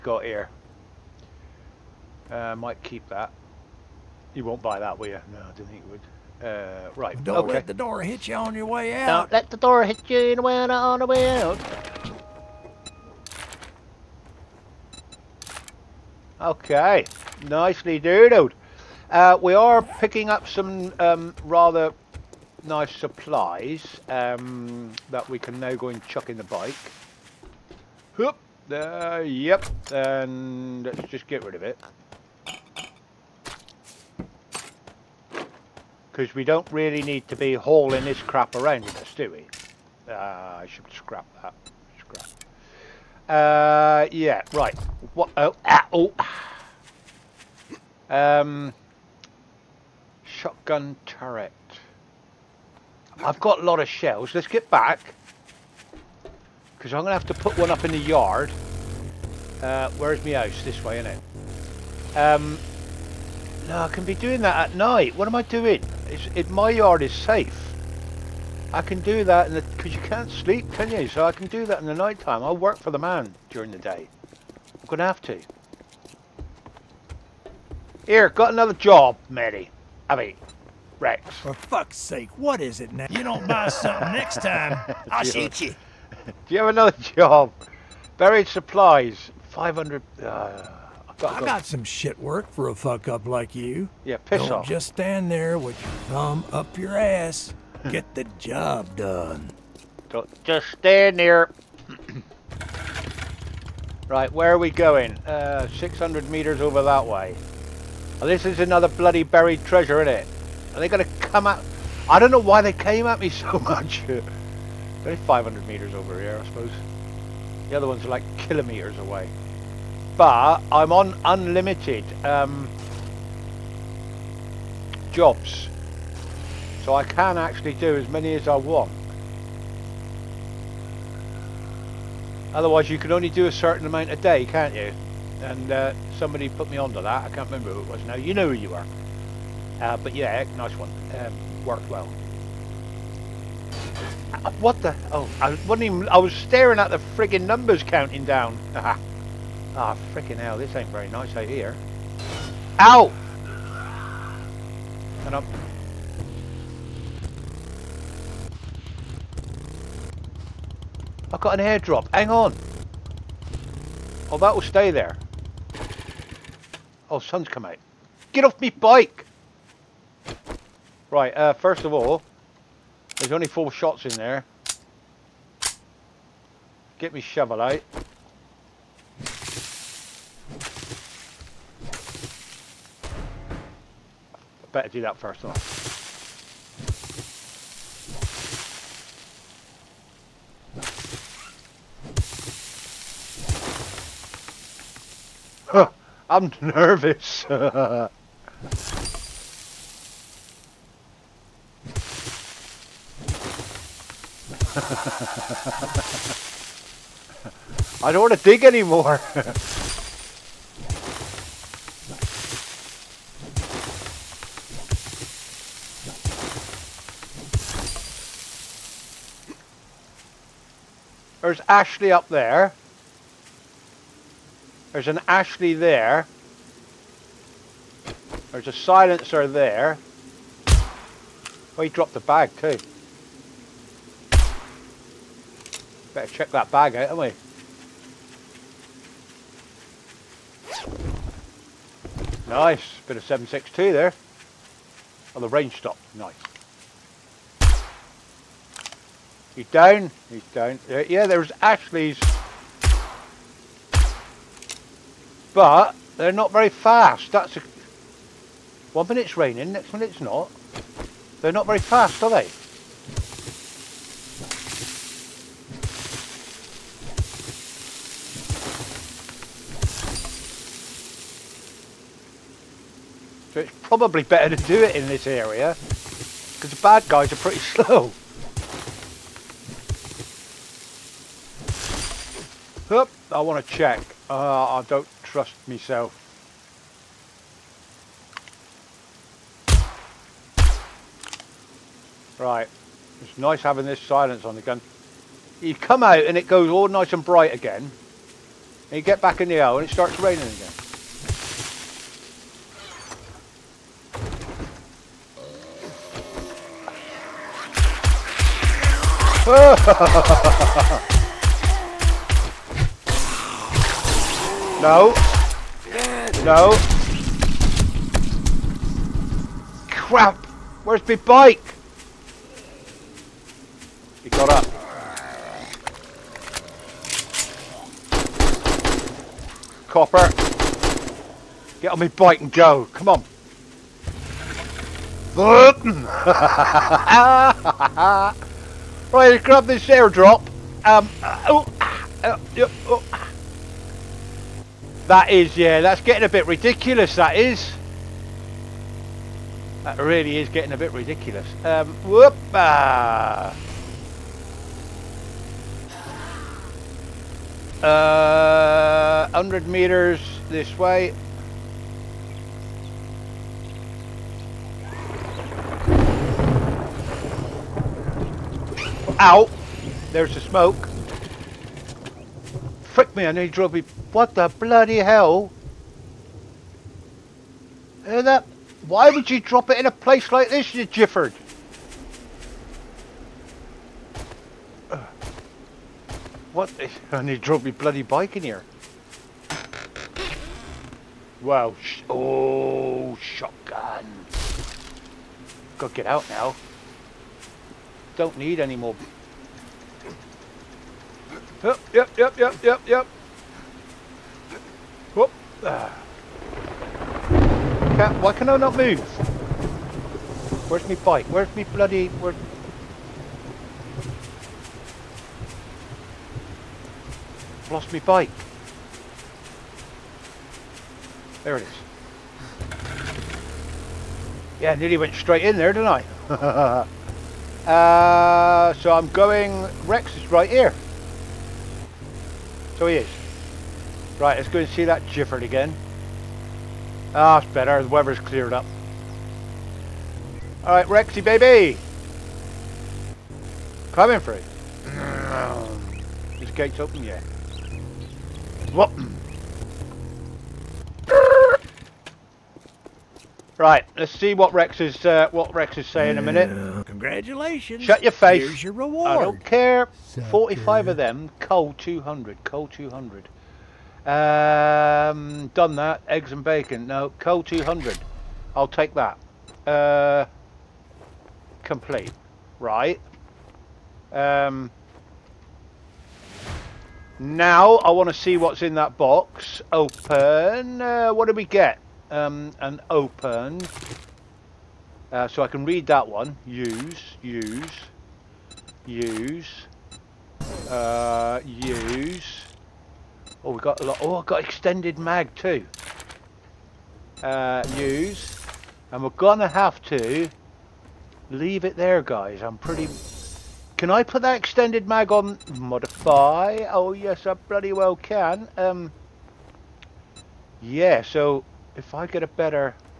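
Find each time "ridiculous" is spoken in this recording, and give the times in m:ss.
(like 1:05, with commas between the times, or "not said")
5:46, 5:50.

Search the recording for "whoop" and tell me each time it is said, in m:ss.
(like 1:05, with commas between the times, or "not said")
0:28, 5:52, 6:45.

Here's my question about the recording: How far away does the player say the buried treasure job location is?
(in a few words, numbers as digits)
600 meters.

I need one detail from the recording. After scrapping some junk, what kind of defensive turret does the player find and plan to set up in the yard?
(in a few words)
Shotgun turret.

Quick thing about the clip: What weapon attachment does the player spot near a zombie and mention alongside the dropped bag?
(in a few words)
Silencer.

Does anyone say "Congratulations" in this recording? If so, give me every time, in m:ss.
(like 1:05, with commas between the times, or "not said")
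7:36.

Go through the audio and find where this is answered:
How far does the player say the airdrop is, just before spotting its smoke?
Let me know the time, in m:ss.
5:59.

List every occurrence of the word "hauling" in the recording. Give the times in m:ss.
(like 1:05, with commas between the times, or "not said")
0:37.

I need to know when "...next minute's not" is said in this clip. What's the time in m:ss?
4:19.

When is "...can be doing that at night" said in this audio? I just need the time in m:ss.
1:03.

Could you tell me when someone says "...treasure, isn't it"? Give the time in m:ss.
1:49.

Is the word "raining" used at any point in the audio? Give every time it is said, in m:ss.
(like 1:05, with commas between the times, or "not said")
4:19, 5:00.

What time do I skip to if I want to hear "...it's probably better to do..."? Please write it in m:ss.
4:33.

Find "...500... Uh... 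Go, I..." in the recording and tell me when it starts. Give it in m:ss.
1:29.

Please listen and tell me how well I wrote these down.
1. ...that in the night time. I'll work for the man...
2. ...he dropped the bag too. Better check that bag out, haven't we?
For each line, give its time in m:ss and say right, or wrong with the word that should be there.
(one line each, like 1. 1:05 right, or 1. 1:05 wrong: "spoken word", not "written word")
1. 1:11 right
2. 3:51 right.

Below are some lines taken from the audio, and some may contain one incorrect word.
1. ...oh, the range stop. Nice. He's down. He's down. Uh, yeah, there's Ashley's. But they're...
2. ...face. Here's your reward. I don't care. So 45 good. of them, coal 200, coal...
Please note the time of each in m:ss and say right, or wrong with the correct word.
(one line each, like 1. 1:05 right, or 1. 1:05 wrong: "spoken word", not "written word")
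1. 4:05 right
2. 7:38 right.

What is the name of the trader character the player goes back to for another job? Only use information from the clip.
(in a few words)
Rex.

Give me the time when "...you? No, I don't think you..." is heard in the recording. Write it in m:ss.
0:05.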